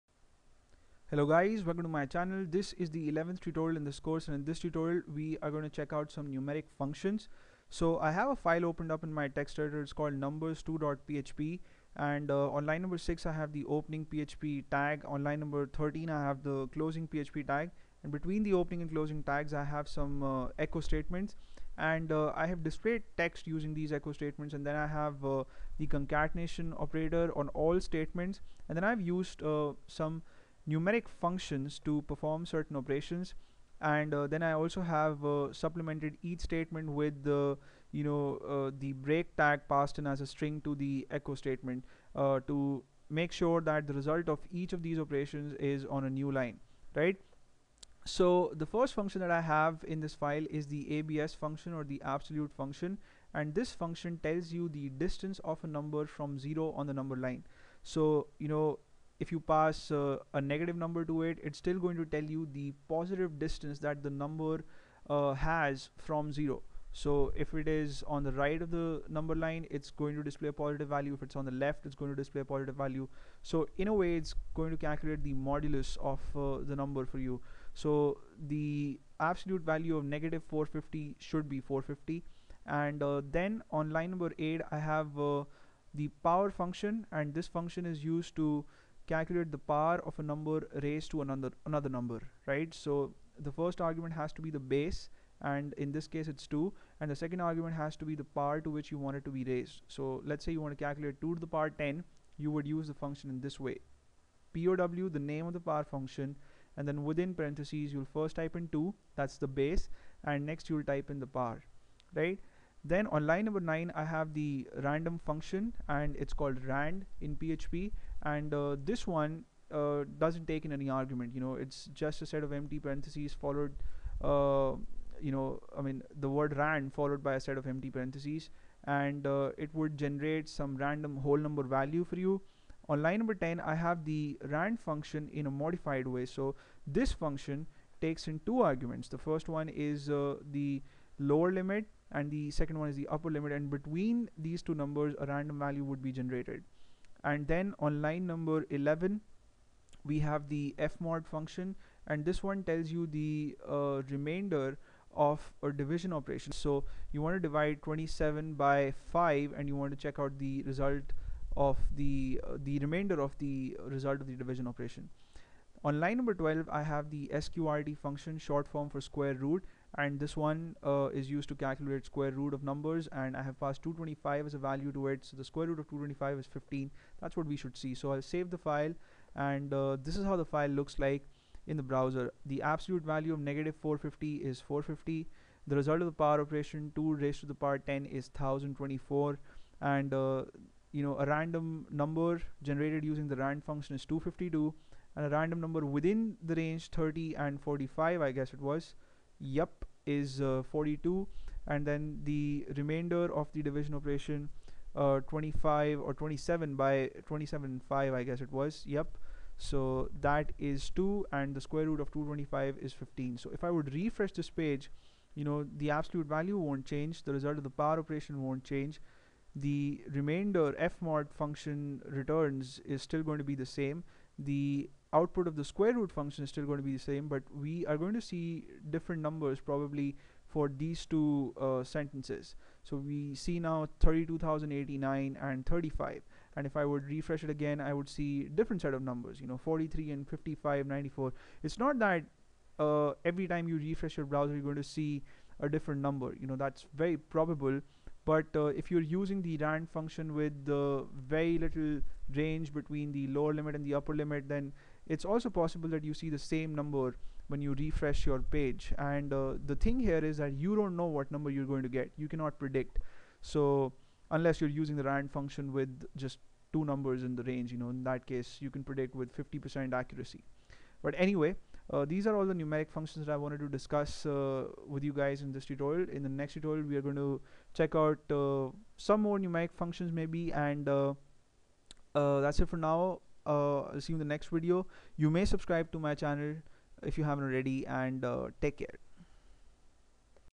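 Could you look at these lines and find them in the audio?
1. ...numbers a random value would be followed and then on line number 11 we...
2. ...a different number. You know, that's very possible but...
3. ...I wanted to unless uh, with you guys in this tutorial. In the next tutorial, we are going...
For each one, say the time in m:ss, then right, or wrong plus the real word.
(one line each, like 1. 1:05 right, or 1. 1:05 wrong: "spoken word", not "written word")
1. 2:24 wrong: "generated", not "followed"
2. 4:05 wrong: "probable", not "possible"
3. 4:33 wrong: "discuss", not "unless".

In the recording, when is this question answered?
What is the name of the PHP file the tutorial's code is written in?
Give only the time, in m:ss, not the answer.
0:10.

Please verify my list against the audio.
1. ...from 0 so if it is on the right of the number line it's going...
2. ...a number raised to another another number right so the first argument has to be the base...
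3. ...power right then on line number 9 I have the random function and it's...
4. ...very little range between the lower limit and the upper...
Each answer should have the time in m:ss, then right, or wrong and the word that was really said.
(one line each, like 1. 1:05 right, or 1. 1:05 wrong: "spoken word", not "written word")
1. 1:06 right
2. 1:30 right
3. 1:51 right
4. 4:11 right.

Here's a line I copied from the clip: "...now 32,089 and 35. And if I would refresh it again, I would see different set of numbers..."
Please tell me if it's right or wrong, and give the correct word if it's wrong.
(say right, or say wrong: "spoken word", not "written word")
right.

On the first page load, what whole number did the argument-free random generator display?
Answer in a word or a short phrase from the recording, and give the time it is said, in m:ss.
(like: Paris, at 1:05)
252, at 3:14.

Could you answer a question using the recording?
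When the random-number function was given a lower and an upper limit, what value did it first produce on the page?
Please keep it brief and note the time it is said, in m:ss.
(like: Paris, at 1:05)
42, at 3:20.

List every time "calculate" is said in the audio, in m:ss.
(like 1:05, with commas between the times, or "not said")
1:14, 1:29, 1:40, 2:51.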